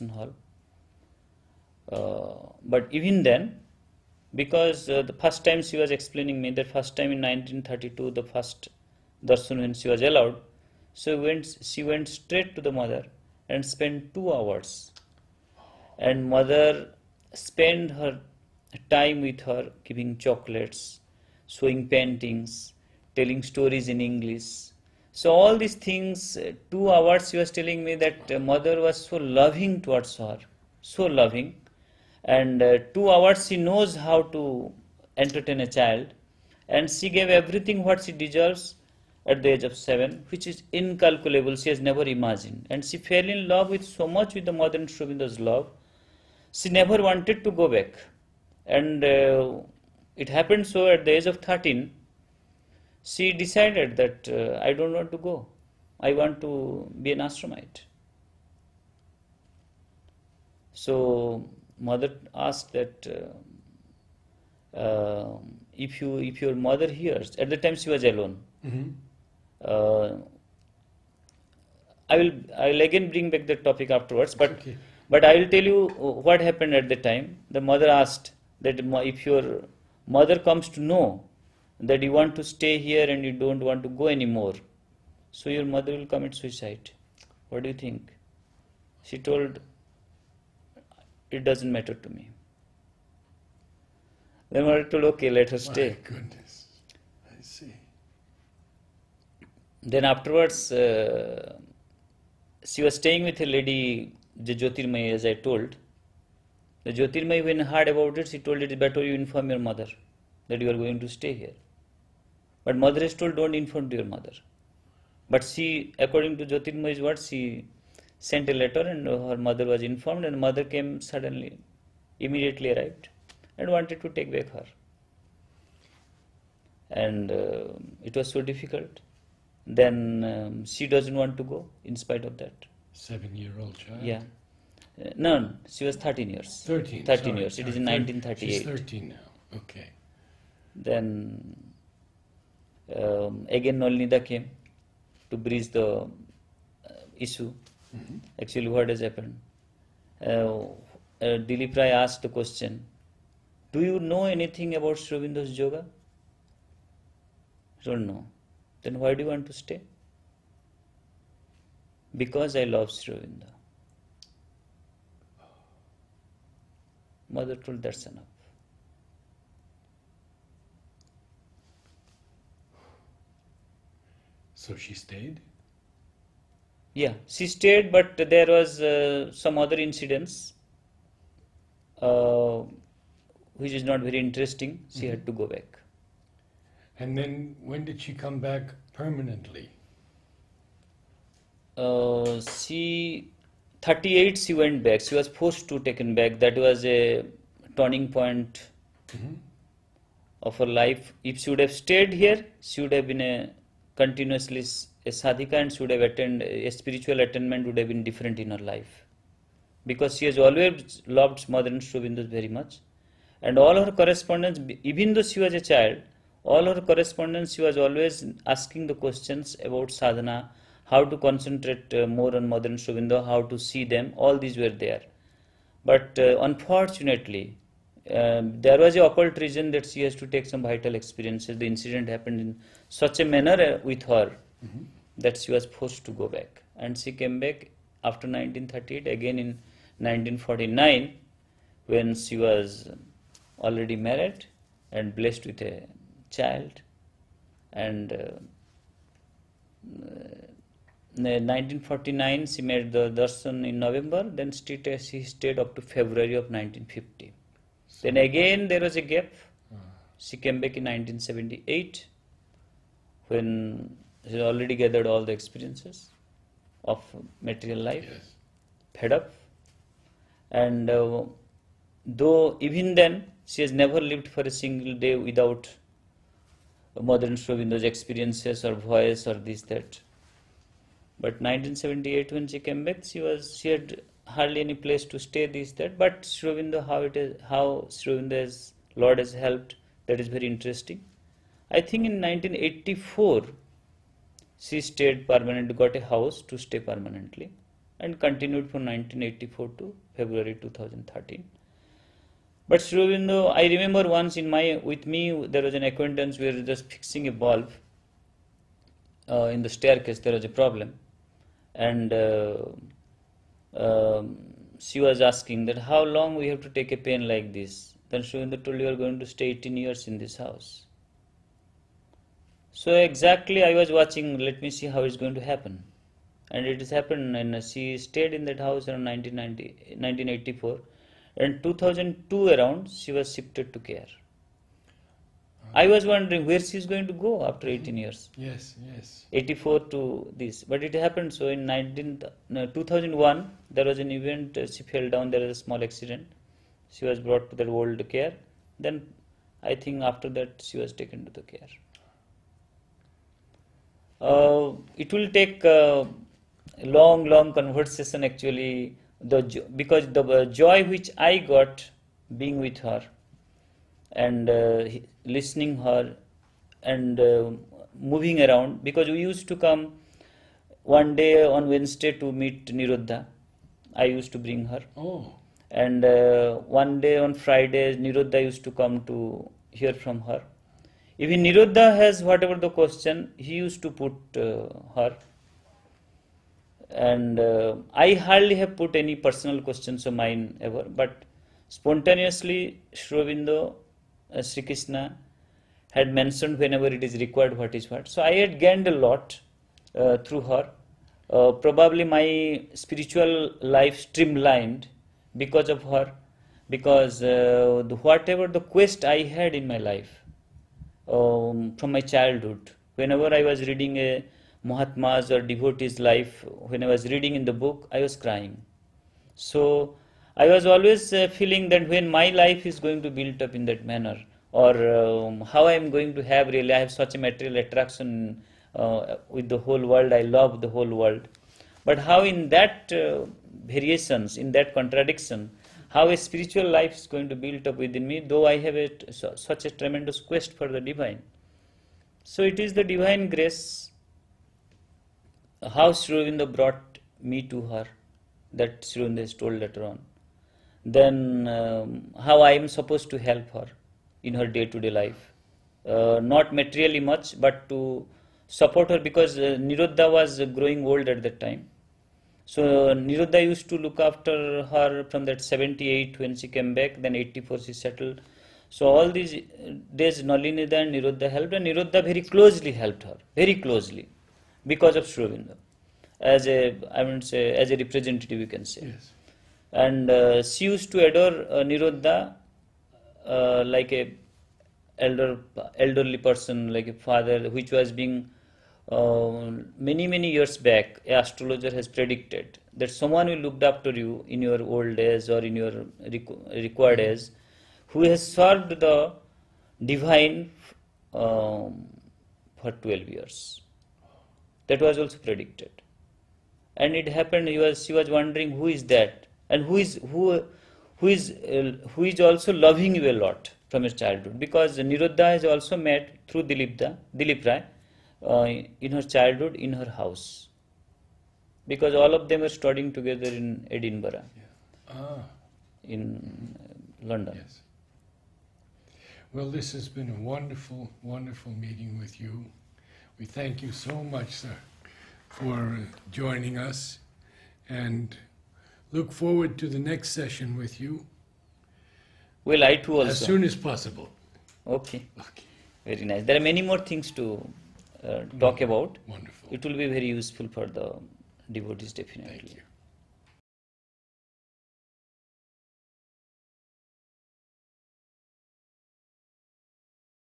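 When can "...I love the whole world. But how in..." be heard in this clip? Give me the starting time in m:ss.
7:10.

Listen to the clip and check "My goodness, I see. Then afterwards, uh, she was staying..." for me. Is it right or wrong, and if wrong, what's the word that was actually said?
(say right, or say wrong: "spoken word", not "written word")
right.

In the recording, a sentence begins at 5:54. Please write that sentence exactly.
Uh, it will take uh, long, long conversation actually.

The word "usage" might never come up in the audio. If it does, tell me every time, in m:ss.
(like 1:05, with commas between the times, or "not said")
not said.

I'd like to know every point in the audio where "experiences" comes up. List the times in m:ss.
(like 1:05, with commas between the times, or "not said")
3:50, 4:25, 4:37.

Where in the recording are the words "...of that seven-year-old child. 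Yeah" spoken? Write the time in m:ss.
2:12.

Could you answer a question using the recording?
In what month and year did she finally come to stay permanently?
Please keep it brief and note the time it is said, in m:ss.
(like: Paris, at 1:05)
February 2013, at 5:00.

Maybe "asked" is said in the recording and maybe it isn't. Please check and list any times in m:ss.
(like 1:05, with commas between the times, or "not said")
1:02, 1:17, 2:32.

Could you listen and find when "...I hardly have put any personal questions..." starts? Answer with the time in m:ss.
6:27.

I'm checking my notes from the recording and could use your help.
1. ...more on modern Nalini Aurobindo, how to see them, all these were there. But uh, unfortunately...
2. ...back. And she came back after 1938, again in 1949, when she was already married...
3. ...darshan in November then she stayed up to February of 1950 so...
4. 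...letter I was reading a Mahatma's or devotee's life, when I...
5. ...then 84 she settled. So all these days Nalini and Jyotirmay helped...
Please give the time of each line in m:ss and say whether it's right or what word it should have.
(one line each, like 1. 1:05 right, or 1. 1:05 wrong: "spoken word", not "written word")
1. 3:42 wrong: "Sri", not "Nalini"
2. 3:56 right
3. 4:13 right
4. 6:52 wrong: "whenever", not "letter"
5. 7:47 wrong: "Nirodda", not "Jyotirmay".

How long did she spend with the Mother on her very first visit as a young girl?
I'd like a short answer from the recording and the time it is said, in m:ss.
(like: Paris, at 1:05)
2 hours, at 0:13.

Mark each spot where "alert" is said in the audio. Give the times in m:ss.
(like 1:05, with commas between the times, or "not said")
not said.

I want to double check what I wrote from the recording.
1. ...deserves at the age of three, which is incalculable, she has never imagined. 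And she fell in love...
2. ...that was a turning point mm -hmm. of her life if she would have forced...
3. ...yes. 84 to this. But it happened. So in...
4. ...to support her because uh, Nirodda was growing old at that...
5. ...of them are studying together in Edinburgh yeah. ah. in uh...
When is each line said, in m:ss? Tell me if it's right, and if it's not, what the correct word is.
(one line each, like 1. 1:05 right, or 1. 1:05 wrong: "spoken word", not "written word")
1. 0:38 wrong: "seven", not "three"
2. 3:16 wrong: "stayed", not "forced"
3. 5:38 right
4. 7:37 right
5. 8:42 right.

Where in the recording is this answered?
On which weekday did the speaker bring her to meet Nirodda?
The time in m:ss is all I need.
6:11.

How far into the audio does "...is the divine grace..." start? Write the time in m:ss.
7:22.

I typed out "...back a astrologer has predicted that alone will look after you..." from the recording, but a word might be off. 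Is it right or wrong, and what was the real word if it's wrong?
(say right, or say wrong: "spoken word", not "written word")
wrong: "someone", not "alone".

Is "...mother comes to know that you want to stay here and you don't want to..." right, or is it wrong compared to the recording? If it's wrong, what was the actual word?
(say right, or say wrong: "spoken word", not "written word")
right.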